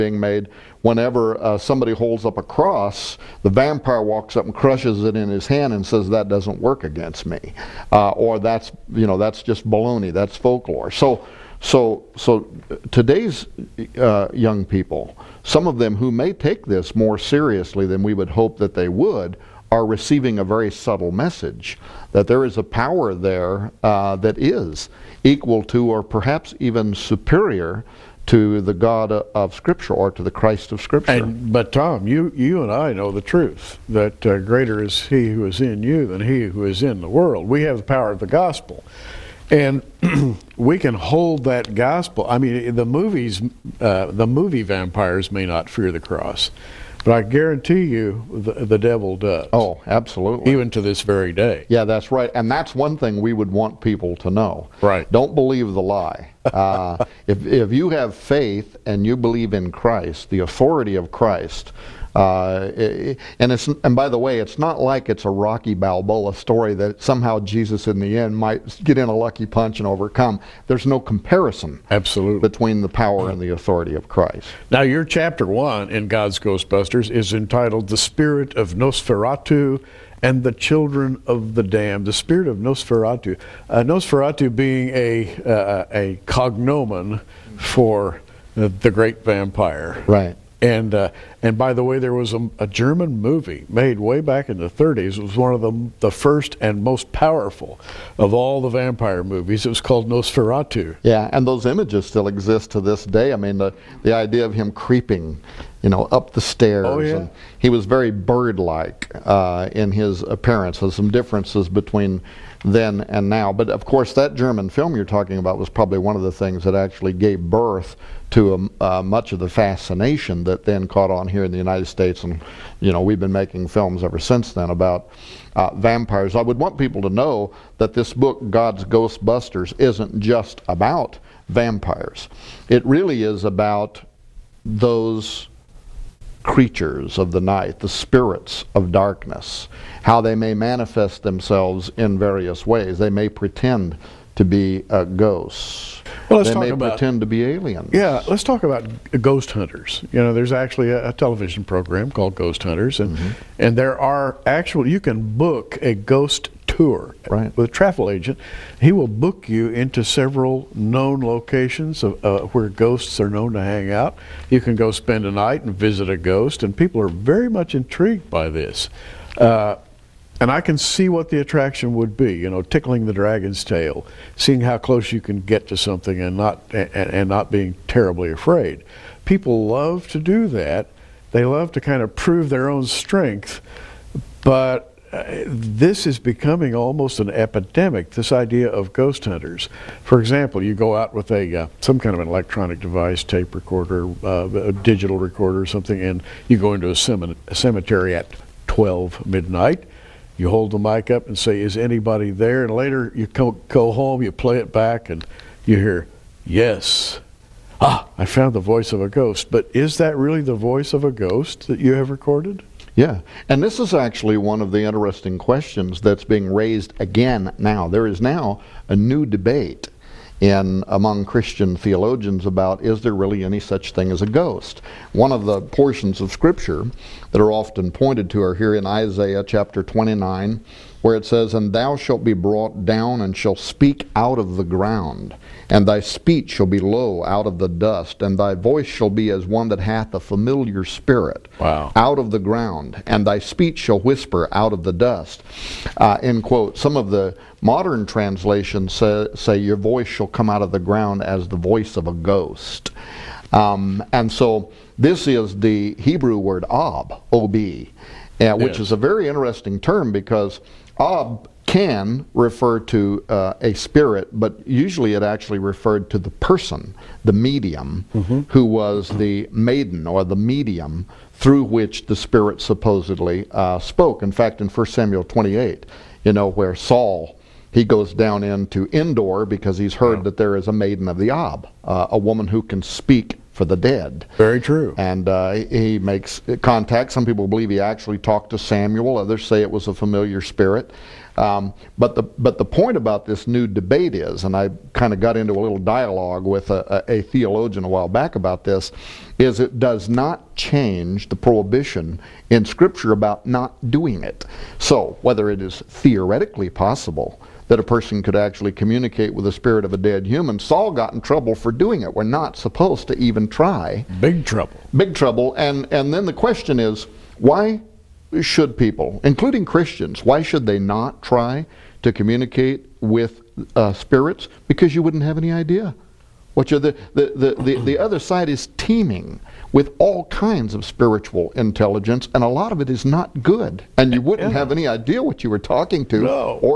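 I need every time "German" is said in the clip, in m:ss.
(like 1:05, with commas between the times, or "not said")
1:32, 1:54.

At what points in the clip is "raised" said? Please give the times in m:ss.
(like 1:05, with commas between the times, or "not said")
3:36.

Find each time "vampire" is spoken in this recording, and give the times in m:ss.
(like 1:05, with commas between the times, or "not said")
0:03, 0:44, 1:29, 1:38, 2:05, 2:11.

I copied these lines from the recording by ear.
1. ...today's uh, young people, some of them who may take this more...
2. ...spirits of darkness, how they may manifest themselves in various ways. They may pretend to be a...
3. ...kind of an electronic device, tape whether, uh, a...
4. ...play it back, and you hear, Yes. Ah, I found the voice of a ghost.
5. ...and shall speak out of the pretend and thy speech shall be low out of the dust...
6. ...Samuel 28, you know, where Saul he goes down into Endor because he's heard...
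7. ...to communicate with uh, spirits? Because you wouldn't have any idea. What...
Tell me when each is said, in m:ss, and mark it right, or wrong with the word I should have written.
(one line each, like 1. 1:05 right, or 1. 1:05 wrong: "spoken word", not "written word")
1. 0:12 right
2. 2:17 right
3. 3:12 wrong: "recorder", not "whether"
4. 3:24 right
5. 3:53 wrong: "ground", not "pretend"
6. 4:34 right
7. 5:22 right.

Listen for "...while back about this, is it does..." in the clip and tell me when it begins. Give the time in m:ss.
4:57.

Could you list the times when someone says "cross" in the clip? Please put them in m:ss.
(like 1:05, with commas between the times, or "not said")
0:02, 0:46.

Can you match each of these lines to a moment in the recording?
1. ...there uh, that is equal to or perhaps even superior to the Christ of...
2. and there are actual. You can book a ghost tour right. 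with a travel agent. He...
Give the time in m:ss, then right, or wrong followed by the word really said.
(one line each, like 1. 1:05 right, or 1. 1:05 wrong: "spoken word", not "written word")
1. 0:23 wrong: "God", not "Christ"
2. 2:33 right.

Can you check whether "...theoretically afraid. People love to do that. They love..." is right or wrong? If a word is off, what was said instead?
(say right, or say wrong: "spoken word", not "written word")
wrong: "terribly", not "theoretically".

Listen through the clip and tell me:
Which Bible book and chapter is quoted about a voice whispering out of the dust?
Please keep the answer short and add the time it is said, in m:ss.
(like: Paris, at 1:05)
Isaiah 29, at 3:48.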